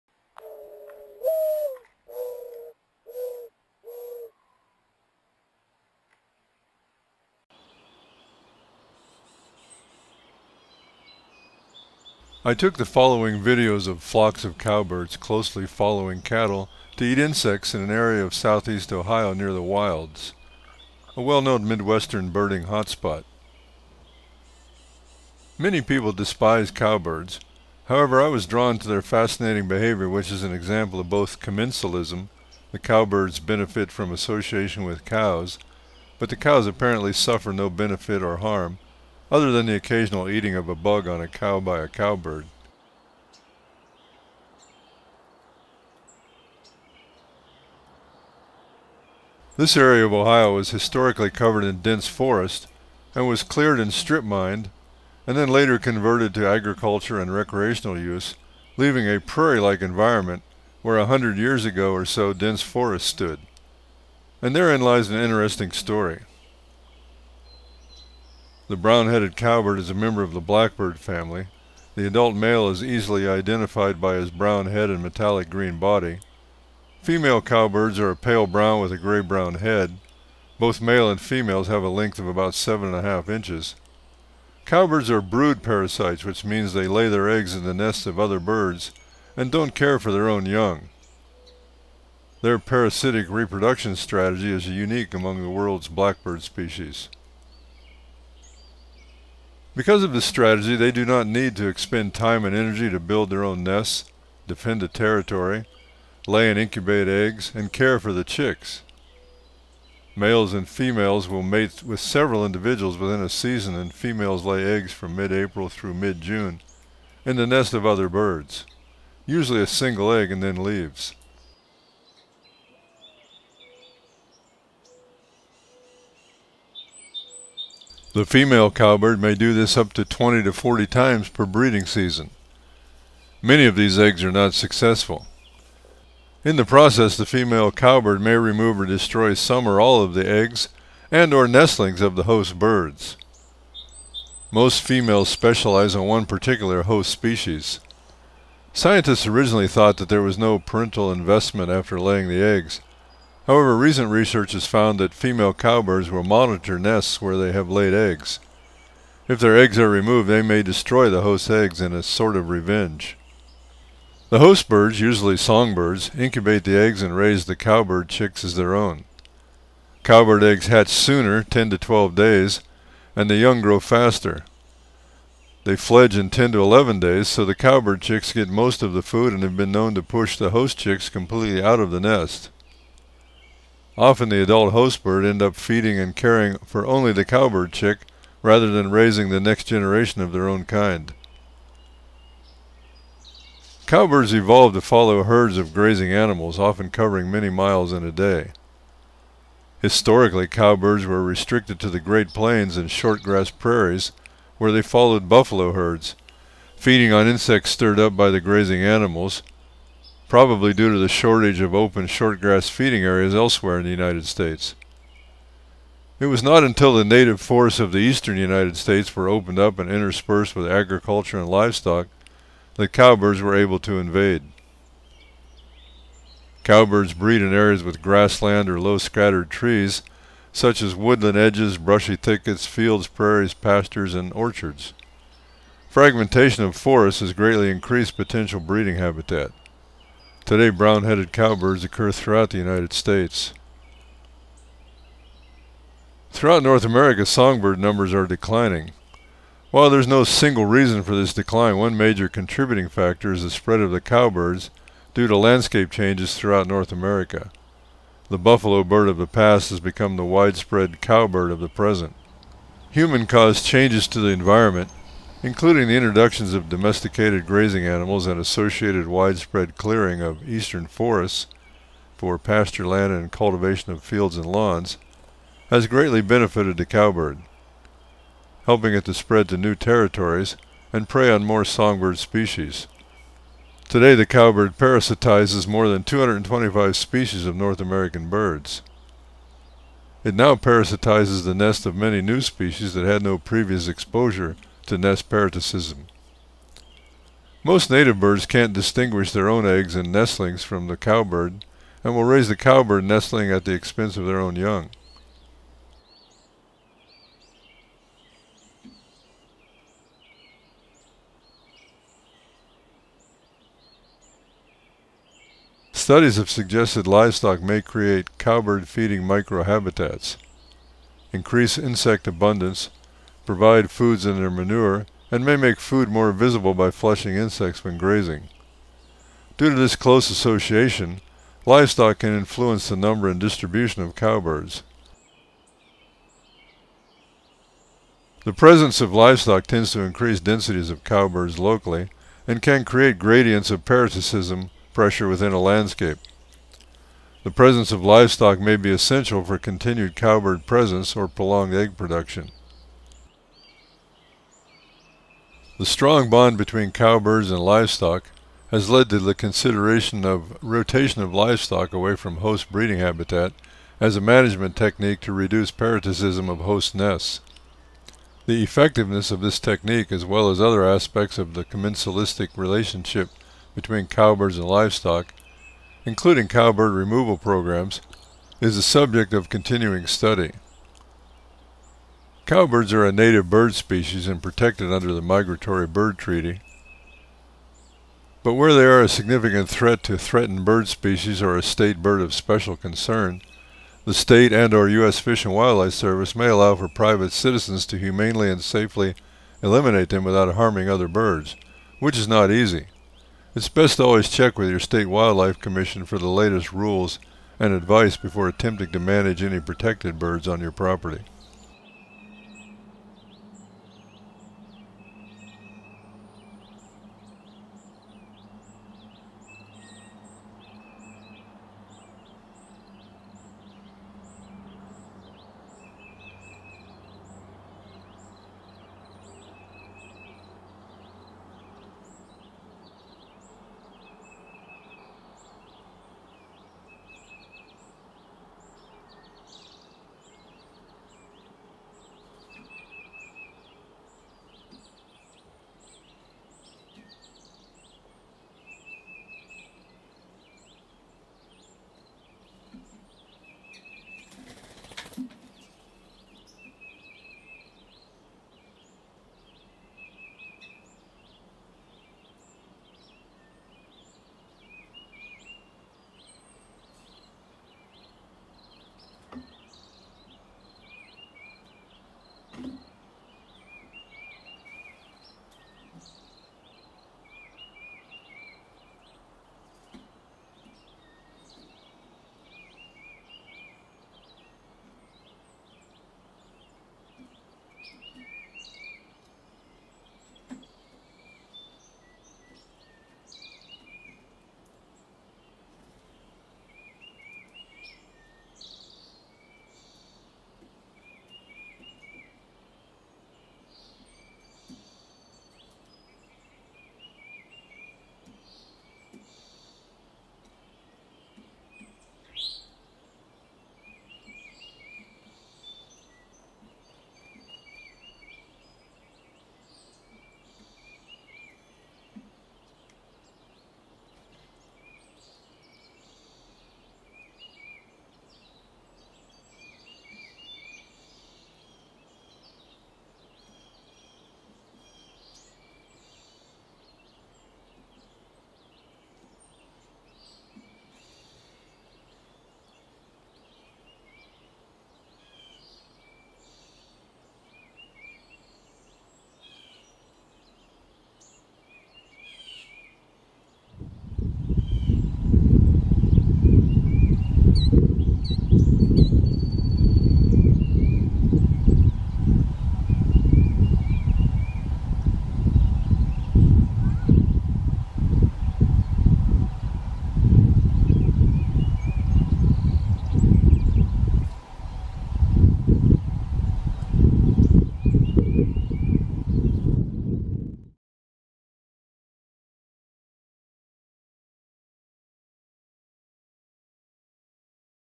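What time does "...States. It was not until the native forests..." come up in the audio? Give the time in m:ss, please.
3:34.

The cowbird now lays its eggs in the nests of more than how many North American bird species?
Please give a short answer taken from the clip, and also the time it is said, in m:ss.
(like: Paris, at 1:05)
225, at 4:46.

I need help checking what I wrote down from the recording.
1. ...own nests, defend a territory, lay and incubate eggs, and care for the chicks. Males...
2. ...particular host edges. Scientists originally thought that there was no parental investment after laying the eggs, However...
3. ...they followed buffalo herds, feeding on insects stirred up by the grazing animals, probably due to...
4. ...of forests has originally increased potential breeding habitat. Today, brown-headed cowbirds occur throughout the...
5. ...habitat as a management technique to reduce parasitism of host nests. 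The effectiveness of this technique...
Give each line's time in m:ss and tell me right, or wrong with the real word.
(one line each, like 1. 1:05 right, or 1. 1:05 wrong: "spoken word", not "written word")
1. 1:43 right
2. 2:26 wrong: "species", not "edges"
3. 3:24 right
4. 3:56 wrong: "greatly", not "originally"
5. 6:02 right.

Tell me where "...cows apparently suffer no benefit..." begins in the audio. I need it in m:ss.
0:36.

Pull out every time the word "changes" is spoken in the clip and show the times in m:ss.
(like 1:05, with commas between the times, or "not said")
4:15, 4:23.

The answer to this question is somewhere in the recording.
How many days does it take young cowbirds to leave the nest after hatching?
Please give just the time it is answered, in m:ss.
2:56.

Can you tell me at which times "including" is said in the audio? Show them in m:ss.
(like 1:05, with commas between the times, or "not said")
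4:25, 6:16.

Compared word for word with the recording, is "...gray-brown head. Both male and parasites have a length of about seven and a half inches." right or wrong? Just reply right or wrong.
wrong.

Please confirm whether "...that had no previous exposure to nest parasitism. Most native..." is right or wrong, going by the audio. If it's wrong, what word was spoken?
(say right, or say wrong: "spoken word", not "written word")
right.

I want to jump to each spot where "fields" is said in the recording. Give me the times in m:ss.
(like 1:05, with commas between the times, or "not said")
3:52, 4:34.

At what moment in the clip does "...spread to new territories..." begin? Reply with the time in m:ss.
4:39.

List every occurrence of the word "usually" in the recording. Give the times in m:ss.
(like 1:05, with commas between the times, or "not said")
1:59, 2:44.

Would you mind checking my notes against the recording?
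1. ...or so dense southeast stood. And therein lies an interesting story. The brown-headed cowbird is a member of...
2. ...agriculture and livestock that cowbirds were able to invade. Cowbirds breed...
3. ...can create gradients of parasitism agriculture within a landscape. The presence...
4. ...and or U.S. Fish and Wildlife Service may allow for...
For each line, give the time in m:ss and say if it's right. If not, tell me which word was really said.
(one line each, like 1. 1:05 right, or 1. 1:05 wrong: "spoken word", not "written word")
1. 1:01 wrong: "forest", not "southeast"
2. 3:40 right
3. 5:42 wrong: "pressure", not "agriculture"
4. 6:34 right.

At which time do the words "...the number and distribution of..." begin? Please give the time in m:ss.
5:32.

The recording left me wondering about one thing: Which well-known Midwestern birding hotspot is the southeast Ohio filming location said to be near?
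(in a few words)
The Wilds.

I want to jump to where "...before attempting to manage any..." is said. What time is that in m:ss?
6:48.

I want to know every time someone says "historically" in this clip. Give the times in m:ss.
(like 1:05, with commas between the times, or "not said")
0:50, 3:19.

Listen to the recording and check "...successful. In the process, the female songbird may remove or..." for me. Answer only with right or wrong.
wrong.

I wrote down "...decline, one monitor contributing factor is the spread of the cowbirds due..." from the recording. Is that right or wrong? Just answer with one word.
wrong.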